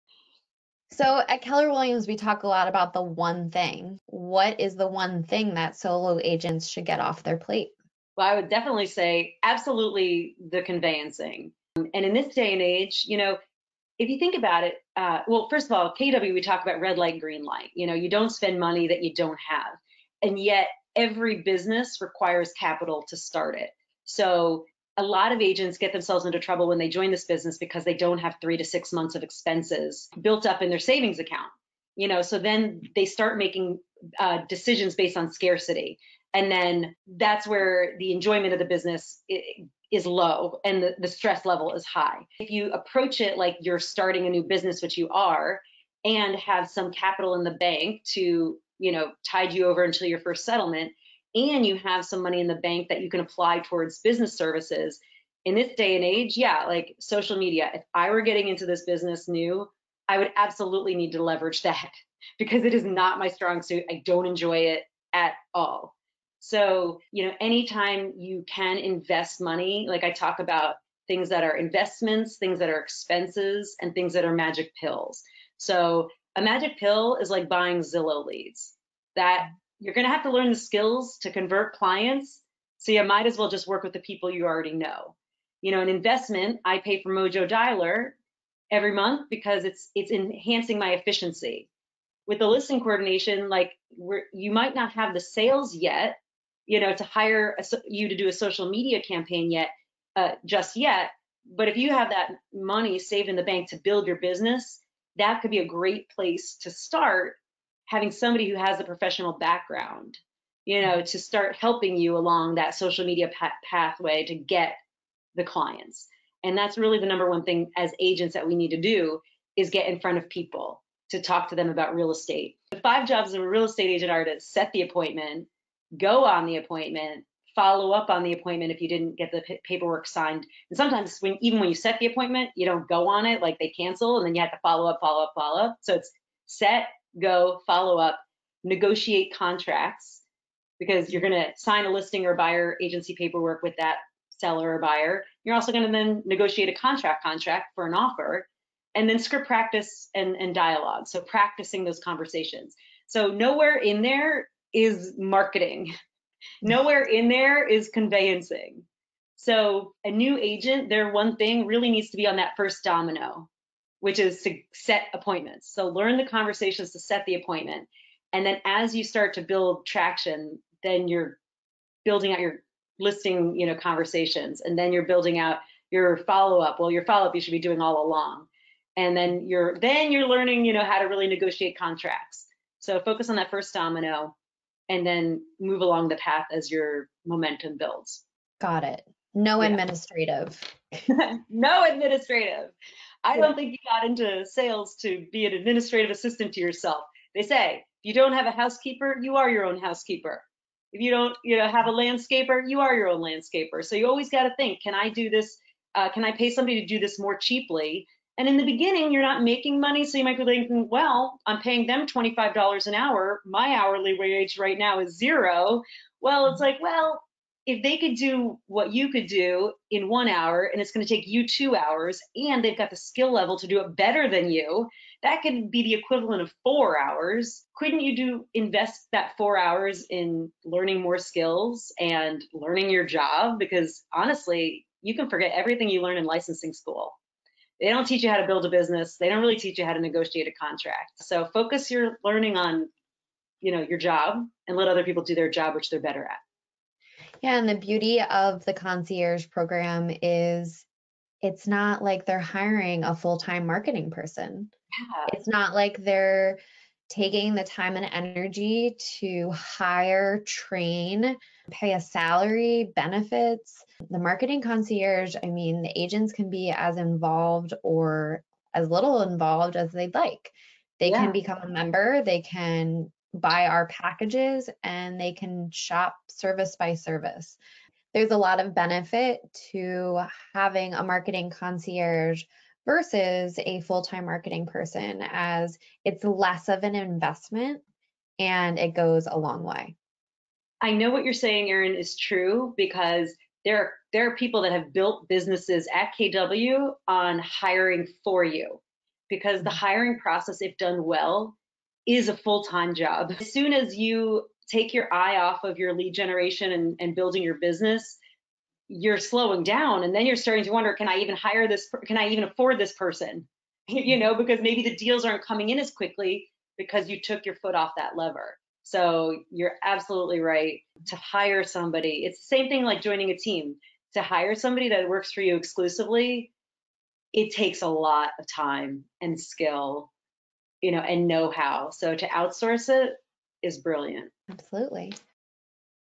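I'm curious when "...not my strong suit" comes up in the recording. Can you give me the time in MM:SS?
01:02.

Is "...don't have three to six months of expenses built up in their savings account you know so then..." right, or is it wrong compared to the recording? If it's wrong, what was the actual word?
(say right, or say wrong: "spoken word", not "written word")
right.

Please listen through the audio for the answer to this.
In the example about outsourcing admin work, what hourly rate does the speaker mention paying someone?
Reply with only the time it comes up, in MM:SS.
03:32.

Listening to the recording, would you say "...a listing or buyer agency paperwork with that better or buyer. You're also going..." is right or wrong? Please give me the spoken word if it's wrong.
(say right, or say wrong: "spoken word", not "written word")
wrong: "seller", not "better".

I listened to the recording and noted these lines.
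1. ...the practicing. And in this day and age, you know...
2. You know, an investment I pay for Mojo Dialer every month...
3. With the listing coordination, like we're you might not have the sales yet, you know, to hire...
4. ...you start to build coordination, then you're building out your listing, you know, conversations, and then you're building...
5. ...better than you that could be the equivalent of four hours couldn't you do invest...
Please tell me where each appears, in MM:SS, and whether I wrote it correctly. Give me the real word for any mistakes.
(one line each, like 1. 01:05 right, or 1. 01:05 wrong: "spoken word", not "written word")
1. 00:10 wrong: "conveyancing", not "practicing"
2. 01:25 right
3. 01:32 right
4. 02:48 wrong: "traction", not "coordination"
5. 03:43 right.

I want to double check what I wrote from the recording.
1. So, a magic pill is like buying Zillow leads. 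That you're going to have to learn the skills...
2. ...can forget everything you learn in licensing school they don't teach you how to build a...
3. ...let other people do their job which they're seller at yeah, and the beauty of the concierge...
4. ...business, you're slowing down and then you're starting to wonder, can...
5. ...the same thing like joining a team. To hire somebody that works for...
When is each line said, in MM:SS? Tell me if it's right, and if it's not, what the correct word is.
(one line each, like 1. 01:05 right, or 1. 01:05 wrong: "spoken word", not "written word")
1. 01:15 right
2. 03:55 right
3. 04:04 wrong: "better", not "seller"
4. 05:07 right
5. 05:22 right.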